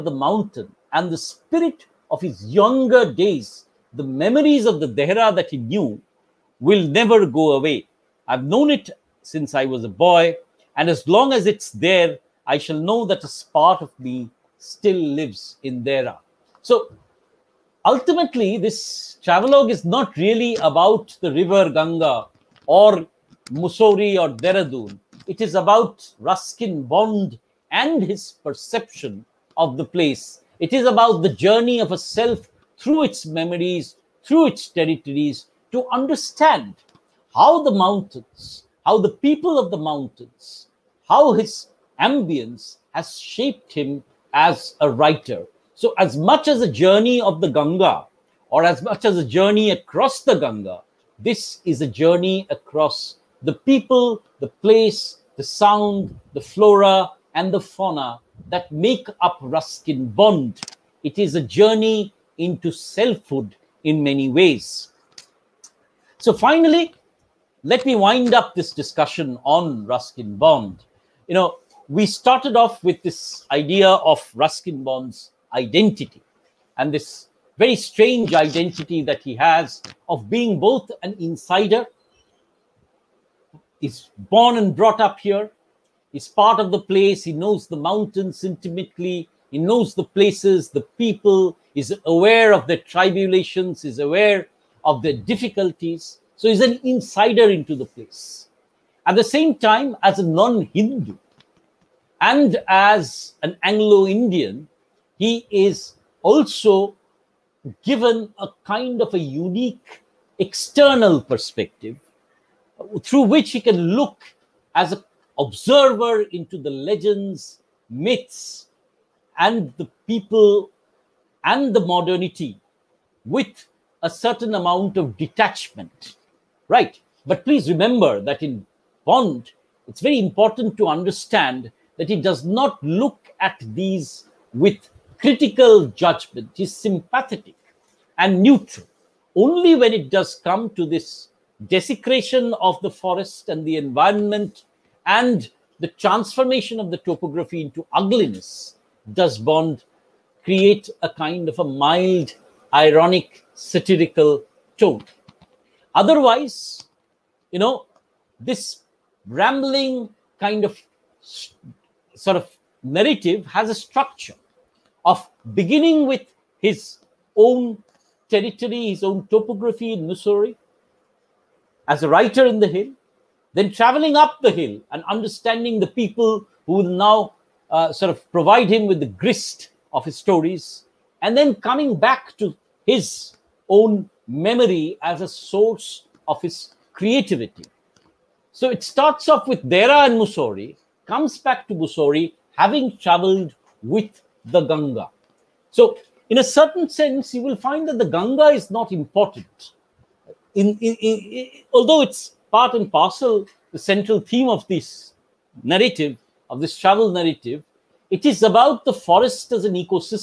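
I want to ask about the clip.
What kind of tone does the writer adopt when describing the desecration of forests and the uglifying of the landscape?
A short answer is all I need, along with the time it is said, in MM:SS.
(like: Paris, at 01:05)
Mild, ironic, satirical, at 02:32.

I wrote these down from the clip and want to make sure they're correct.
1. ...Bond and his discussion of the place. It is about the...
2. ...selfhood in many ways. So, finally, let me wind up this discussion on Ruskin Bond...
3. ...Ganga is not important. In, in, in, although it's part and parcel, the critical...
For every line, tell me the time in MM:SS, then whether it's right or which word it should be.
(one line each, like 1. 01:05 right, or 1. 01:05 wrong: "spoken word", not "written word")
1. 00:26 wrong: "perception", not "discussion"
2. 01:02 right
3. 03:18 wrong: "central", not "critical".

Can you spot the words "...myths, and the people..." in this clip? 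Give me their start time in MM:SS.
01:57.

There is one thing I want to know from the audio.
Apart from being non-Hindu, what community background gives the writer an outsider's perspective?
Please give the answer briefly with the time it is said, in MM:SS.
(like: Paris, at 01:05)
Anglo Indian, at 01:43.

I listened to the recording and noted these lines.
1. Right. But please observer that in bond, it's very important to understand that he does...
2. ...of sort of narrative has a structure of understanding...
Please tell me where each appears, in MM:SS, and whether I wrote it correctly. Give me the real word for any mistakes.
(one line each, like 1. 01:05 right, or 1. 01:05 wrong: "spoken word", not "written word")
1. 02:06 wrong: "remember", not "observer"
2. 02:40 wrong: "beginning", not "understanding".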